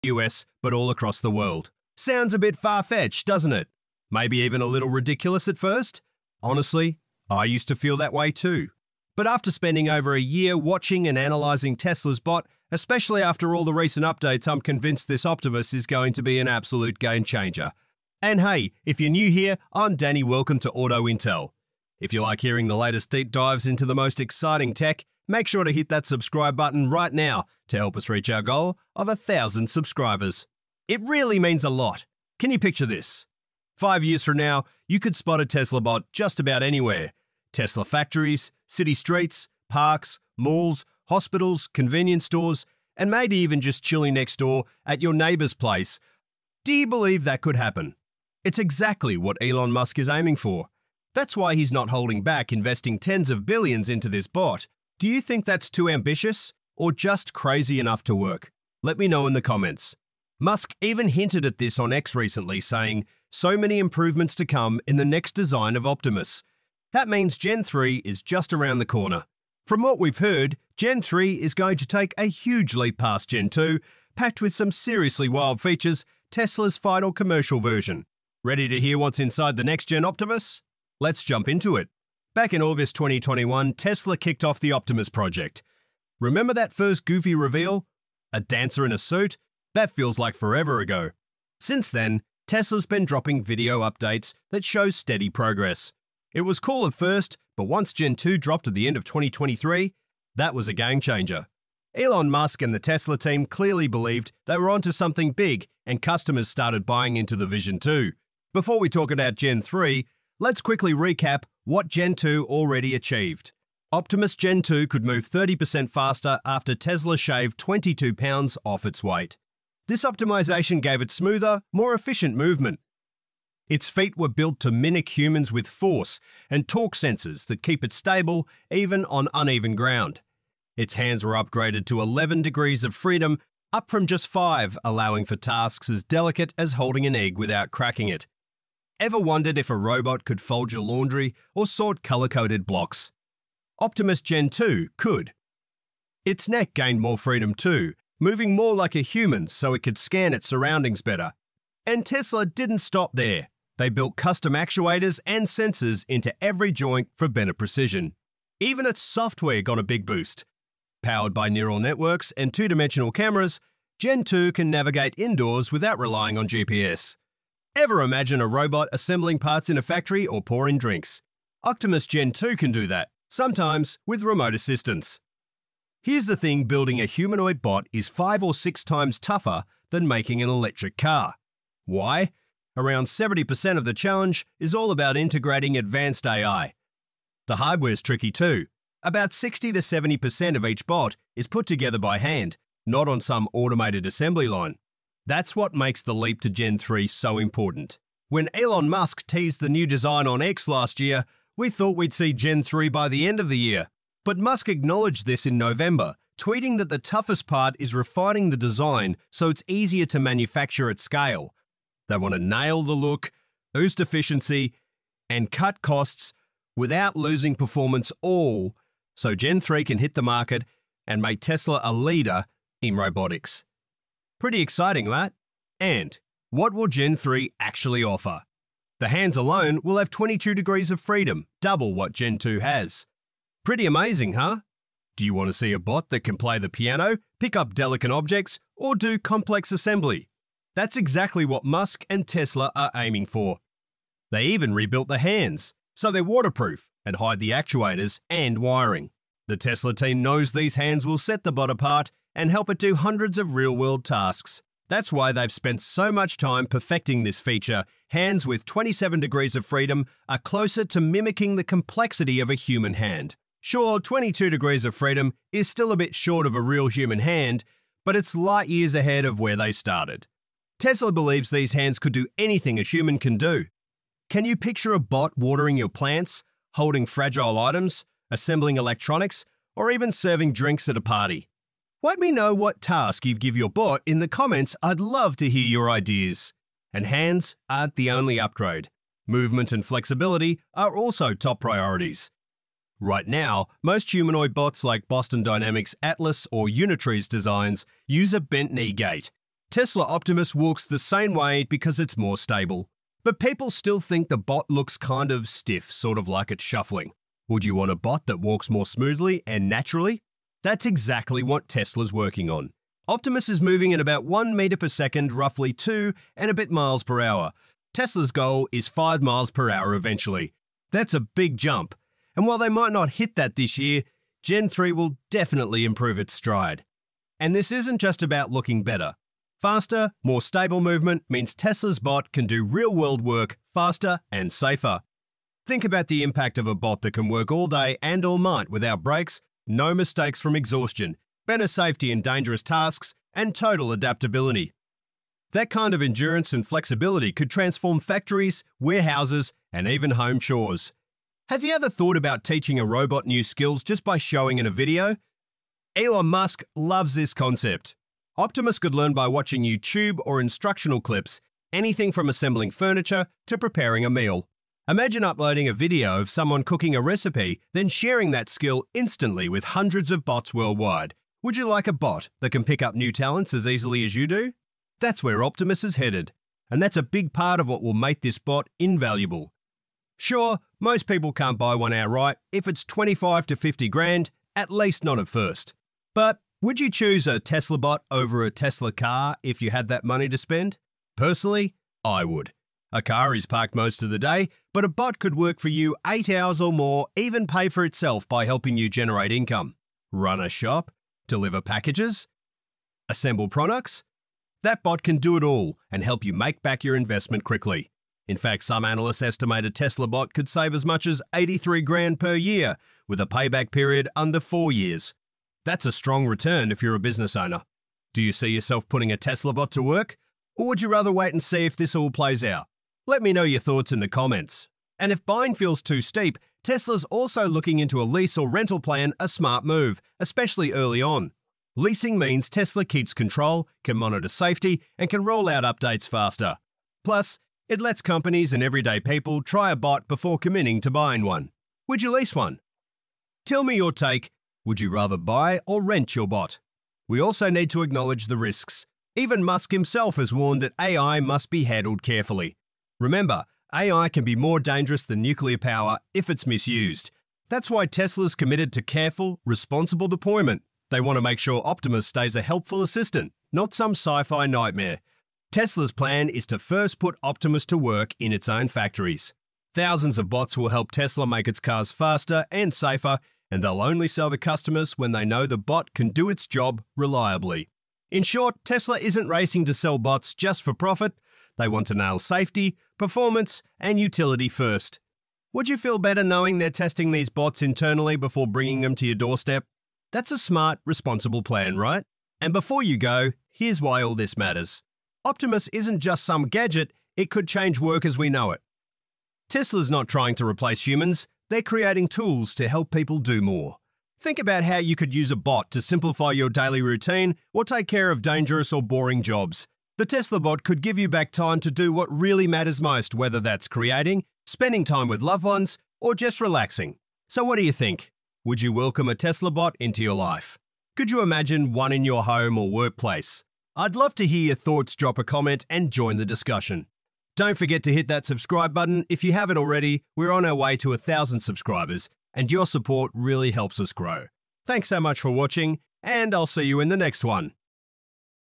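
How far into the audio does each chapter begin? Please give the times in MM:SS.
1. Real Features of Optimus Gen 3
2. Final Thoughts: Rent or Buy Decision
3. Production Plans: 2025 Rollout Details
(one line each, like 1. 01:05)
1. 06:05
2. 08:30
3. 03:15.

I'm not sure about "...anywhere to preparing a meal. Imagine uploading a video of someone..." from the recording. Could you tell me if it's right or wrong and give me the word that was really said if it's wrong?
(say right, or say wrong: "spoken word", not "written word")
wrong: "furniture", not "anywhere".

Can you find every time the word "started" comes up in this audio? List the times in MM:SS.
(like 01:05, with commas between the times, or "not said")
01:46, 04:29.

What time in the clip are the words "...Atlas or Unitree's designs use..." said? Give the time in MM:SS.
04:56.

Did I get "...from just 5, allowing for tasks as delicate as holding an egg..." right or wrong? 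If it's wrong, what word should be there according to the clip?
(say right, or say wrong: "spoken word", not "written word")
right.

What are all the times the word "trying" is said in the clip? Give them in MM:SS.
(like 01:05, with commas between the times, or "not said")
08:20.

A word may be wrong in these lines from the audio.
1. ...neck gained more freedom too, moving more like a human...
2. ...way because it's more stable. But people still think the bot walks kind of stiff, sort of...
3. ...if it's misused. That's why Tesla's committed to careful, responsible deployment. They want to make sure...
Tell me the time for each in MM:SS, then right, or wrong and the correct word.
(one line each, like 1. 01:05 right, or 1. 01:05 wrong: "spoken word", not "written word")
1. 02:26 right
2. 05:01 wrong: "looks", not "walks"
3. 07:36 right.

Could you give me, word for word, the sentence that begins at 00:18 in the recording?
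And hey, if you're new here, I'm Danny.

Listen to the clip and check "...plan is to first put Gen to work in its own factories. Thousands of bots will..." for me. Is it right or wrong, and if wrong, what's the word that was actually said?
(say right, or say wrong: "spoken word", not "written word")
wrong: "Optimus", not "Gen".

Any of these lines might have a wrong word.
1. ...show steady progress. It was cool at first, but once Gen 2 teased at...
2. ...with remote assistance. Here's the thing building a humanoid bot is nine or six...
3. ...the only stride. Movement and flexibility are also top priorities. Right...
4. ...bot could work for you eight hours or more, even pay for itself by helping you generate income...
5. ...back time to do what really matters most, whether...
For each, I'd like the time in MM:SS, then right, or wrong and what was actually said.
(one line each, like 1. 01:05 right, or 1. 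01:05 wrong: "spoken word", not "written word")
1. 01:34 wrong: "dropped", not "teased"
2. 02:54 wrong: "five", not "nine"
3. 04:47 wrong: "upgrade", not "stride"
4. 06:34 right
5. 08:31 right.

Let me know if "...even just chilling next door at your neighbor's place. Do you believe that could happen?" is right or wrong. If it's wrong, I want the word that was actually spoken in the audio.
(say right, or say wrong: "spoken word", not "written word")
right.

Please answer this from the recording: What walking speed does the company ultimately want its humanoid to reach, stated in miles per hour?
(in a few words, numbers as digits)
5 miles per hour.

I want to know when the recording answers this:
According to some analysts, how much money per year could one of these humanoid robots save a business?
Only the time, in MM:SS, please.
06:51.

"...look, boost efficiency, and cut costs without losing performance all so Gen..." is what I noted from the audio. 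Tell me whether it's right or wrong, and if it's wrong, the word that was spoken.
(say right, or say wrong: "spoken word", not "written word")
right.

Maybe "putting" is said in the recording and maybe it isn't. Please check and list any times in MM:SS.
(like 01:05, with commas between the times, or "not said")
06:58.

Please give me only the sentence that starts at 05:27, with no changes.
And this isn't just about looking better.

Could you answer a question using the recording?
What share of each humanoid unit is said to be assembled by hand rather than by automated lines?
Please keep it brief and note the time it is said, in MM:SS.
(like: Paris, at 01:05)
60 to 70%, at 03:09.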